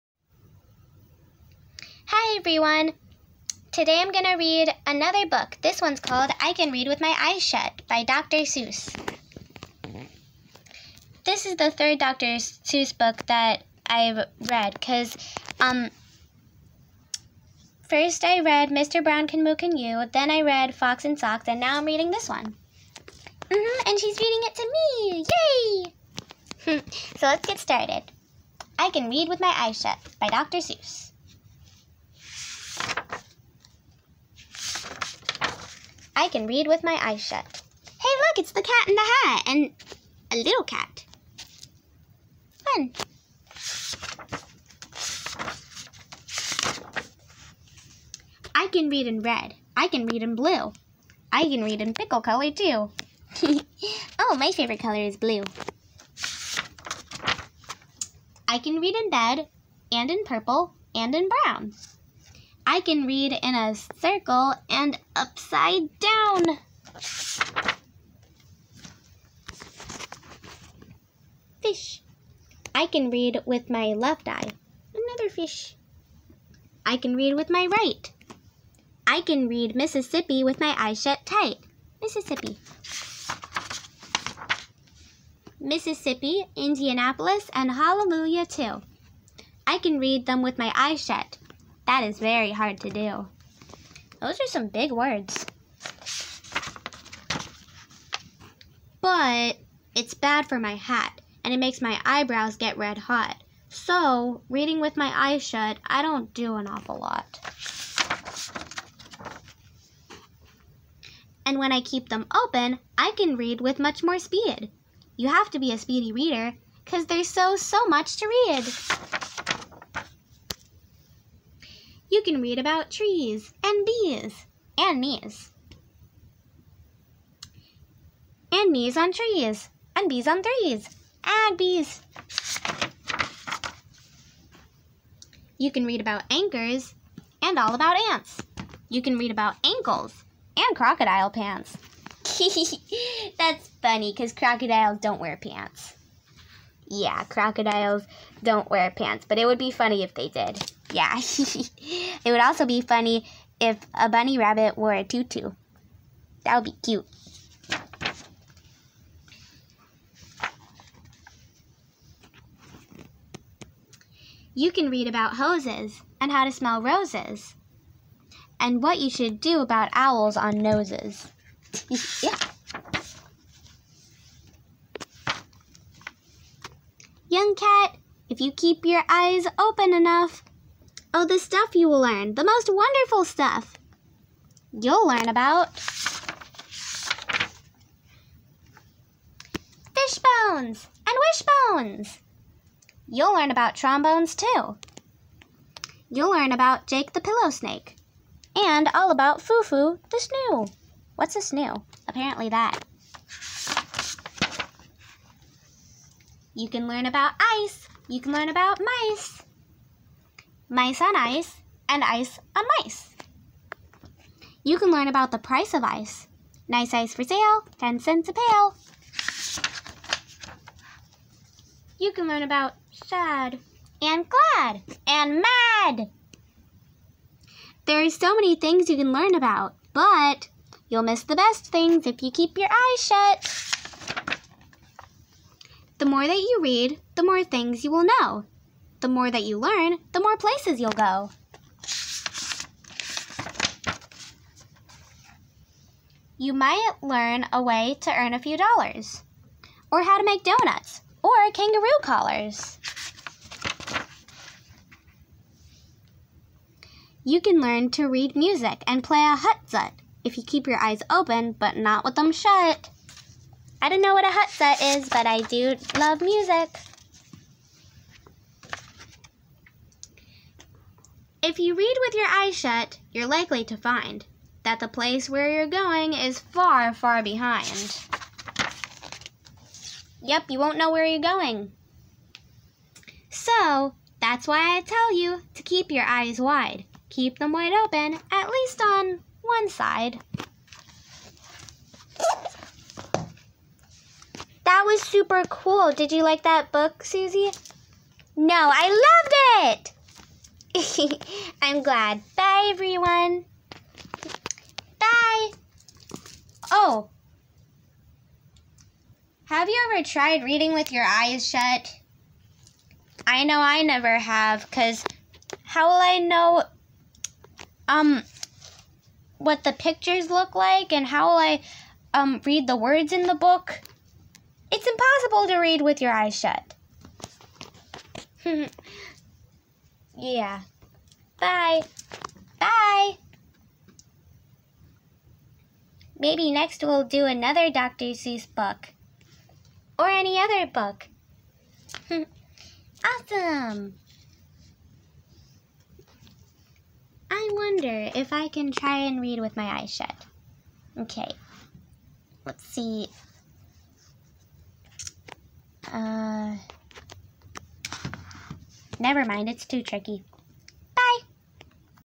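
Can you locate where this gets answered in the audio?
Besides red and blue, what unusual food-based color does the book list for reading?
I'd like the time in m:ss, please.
0:51.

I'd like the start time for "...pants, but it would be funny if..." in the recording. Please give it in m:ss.
2:28.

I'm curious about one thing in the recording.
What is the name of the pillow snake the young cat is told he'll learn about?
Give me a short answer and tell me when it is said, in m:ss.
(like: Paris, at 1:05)
Jake, at 3:16.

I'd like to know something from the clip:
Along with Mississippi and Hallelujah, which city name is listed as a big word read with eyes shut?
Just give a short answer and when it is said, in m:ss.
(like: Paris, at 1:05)
Indianapolis, at 1:26.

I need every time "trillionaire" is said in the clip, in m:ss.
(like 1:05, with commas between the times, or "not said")
not said.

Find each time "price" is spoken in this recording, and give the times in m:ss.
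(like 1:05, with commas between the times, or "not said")
3:35.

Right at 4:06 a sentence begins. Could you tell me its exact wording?
You might learn a way to earn a few dollars, or how to make donuts, or kangaroo collars.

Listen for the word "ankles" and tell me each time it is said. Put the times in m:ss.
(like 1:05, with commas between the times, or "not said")
2:19.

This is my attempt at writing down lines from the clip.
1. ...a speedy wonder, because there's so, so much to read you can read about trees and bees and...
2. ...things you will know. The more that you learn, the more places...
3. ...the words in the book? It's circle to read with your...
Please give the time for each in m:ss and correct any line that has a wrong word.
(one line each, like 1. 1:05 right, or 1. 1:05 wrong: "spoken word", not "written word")
1. 1:55 wrong: "reader", not "wonder"
2. 3:57 right
3. 5:22 wrong: "impossible", not "circle".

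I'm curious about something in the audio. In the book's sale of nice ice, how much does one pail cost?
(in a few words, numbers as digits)
10 cents.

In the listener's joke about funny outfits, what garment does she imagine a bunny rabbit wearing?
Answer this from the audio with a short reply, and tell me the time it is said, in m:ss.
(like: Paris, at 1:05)
a tutu, at 2:35.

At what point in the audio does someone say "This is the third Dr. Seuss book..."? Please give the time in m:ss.
0:11.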